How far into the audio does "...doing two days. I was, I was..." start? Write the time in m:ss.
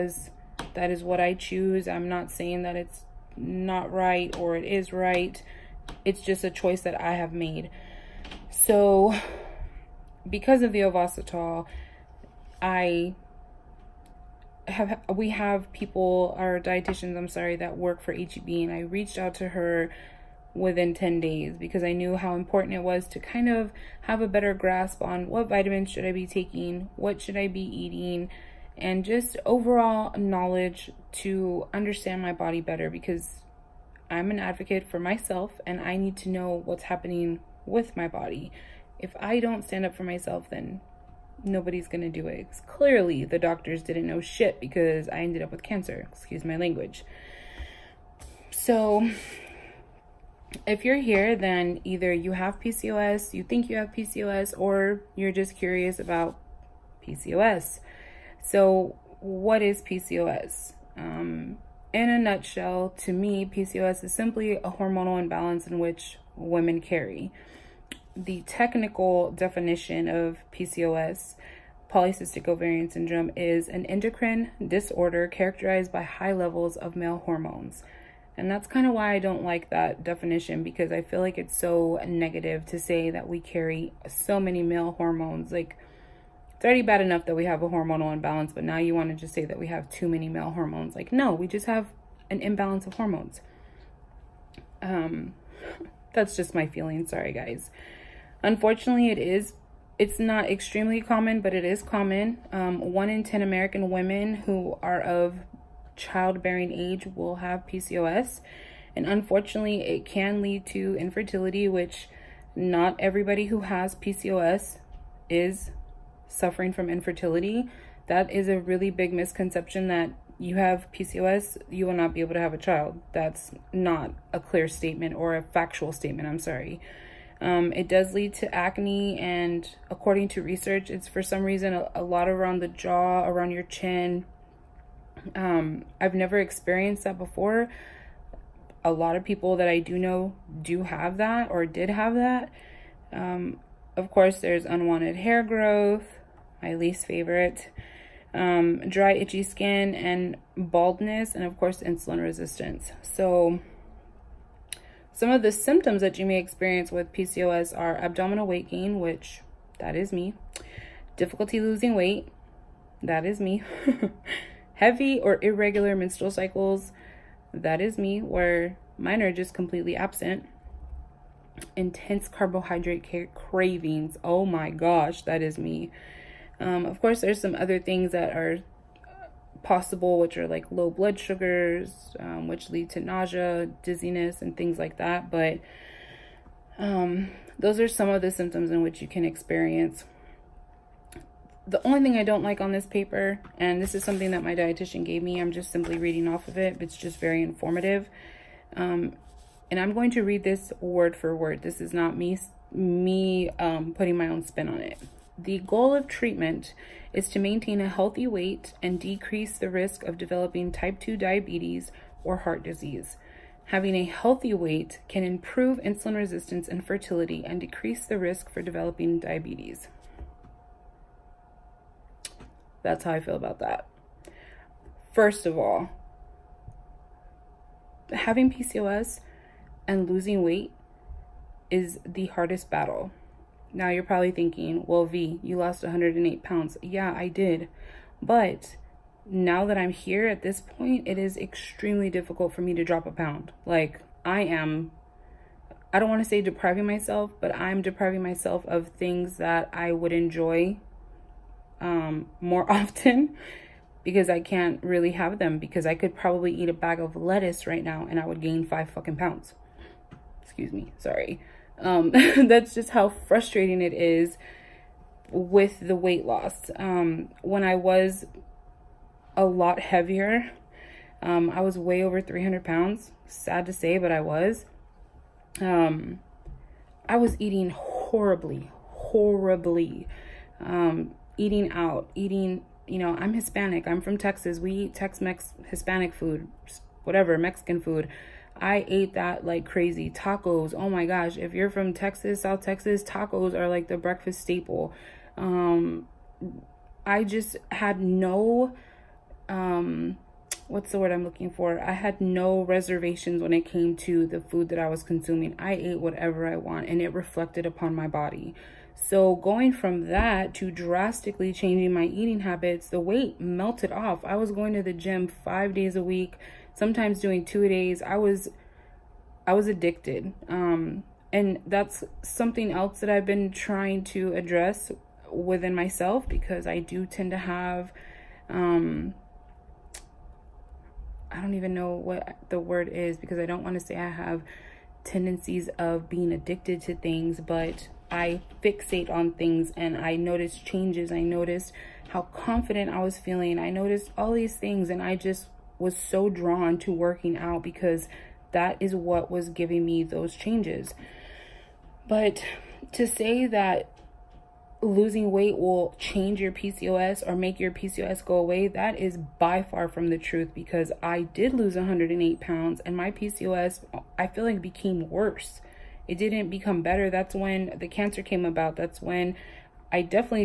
5:17.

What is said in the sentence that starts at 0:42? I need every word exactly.
Because clearly, the doctors didn't know shit because I ended up with cancer.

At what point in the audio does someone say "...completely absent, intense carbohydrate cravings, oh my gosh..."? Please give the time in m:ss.
2:49.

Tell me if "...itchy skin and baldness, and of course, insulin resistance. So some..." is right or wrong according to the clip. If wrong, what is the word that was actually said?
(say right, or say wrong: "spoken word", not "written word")
right.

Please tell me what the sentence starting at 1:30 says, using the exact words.
Like, no, we just have an imbalance of hormones.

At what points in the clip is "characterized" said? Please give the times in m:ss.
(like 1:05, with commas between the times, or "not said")
1:15.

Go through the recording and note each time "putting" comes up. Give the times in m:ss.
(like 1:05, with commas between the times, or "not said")
3:23.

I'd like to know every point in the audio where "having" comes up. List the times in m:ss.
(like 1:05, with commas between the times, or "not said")
3:33, 3:48.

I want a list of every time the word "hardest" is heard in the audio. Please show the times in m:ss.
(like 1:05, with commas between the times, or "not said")
3:52.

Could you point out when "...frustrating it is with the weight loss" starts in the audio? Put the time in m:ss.
4:23.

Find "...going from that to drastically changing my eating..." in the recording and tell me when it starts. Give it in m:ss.
5:09.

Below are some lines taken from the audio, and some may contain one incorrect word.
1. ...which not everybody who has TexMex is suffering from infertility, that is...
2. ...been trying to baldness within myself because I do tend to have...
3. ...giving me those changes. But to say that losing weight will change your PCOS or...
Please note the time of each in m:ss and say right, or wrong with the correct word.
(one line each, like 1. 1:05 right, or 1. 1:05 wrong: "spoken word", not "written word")
1. 1:51 wrong: "PCOS", not "TexMex"
2. 5:23 wrong: "address", not "baldness"
3. 5:49 right.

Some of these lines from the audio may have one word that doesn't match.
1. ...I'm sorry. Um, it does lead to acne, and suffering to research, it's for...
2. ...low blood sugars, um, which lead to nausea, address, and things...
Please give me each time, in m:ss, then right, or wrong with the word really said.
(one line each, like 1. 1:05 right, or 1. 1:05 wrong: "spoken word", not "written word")
1. 2:06 wrong: "according", not "suffering"
2. 3:00 wrong: "dizziness", not "address".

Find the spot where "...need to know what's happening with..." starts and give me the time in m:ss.
0:35.